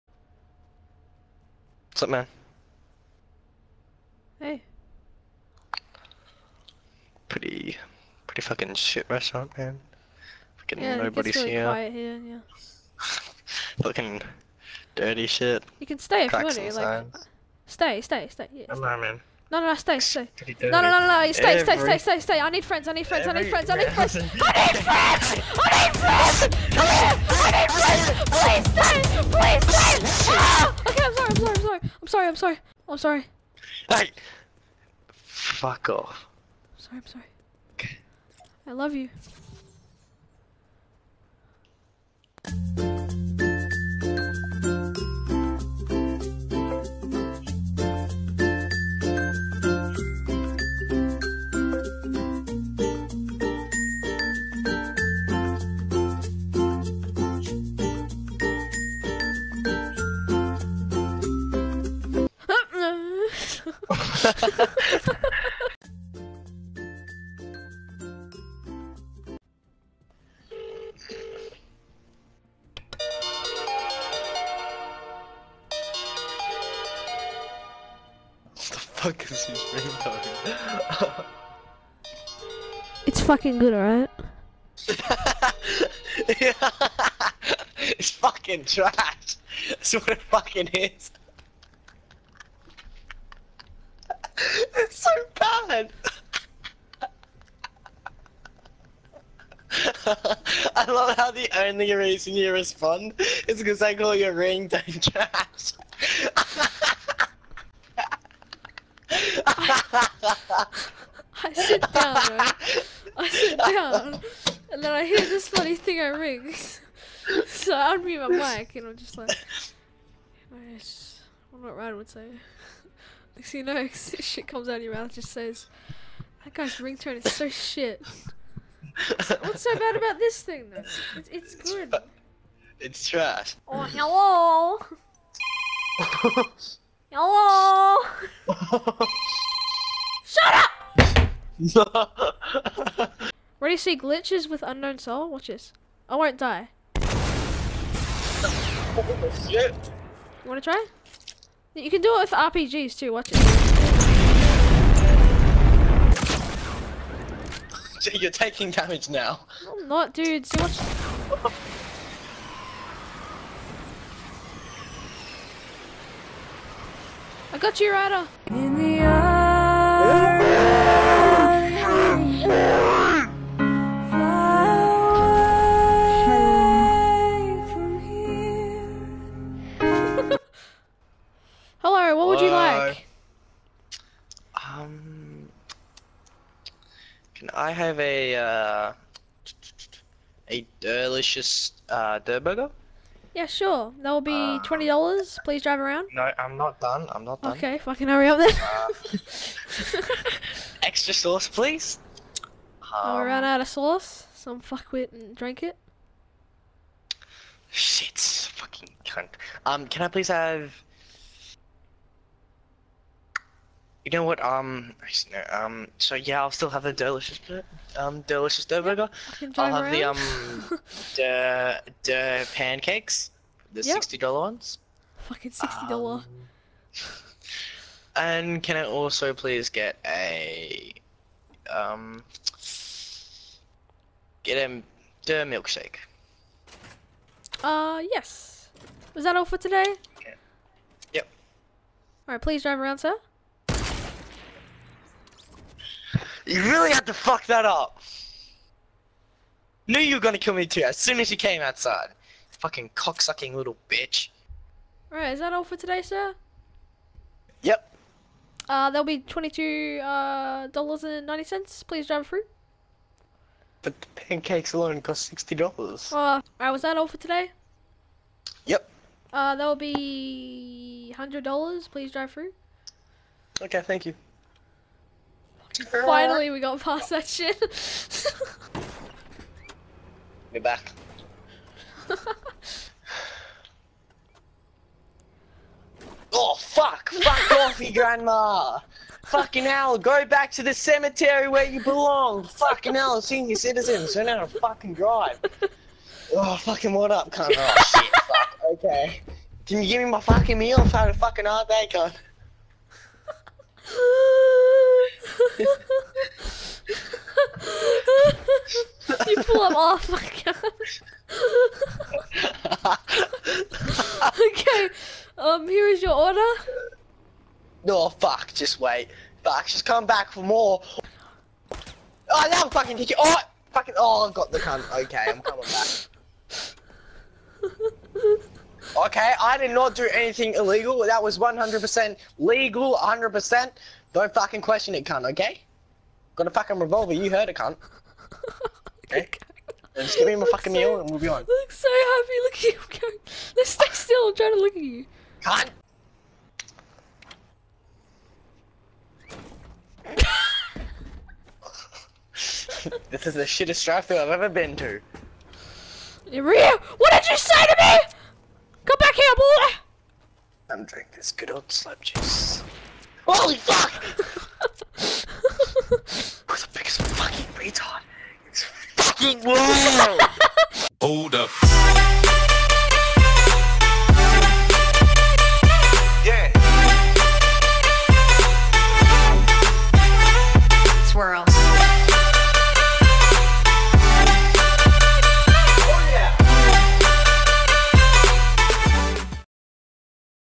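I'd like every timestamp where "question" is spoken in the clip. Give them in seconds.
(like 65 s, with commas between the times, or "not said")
334 s.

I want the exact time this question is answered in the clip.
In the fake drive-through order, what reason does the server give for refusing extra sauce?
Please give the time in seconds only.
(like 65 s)
202 s.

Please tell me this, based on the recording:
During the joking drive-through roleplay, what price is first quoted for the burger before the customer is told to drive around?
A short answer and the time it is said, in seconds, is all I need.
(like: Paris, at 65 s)
$20, at 194 s.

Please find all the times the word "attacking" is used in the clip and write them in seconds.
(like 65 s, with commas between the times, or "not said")
not said.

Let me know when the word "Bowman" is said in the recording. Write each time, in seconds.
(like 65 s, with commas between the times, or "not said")
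not said.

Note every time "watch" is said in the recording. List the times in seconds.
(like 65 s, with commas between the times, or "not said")
145 s, 153 s, 160 s.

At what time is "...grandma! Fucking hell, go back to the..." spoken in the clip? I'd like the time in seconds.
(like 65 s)
287 s.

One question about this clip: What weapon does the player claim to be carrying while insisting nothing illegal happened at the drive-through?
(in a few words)
Revolver.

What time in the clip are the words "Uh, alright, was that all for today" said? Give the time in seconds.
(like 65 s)
266 s.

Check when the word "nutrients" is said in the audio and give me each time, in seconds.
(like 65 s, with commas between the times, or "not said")
not said.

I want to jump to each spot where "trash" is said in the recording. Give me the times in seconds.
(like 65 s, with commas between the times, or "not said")
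88 s, 104 s, 133 s.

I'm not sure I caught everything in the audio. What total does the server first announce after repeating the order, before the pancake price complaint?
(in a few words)
$22.90.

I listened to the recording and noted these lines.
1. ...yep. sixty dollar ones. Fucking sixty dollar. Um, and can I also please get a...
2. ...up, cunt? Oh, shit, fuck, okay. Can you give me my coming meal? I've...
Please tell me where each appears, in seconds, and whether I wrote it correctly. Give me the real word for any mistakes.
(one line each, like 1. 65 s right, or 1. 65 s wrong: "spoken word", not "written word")
1. 223 s right
2. 297 s wrong: "fucking", not "coming".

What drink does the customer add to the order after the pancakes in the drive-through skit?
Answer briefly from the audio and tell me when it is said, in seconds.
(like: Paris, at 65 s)
Milkshake, at 235 s.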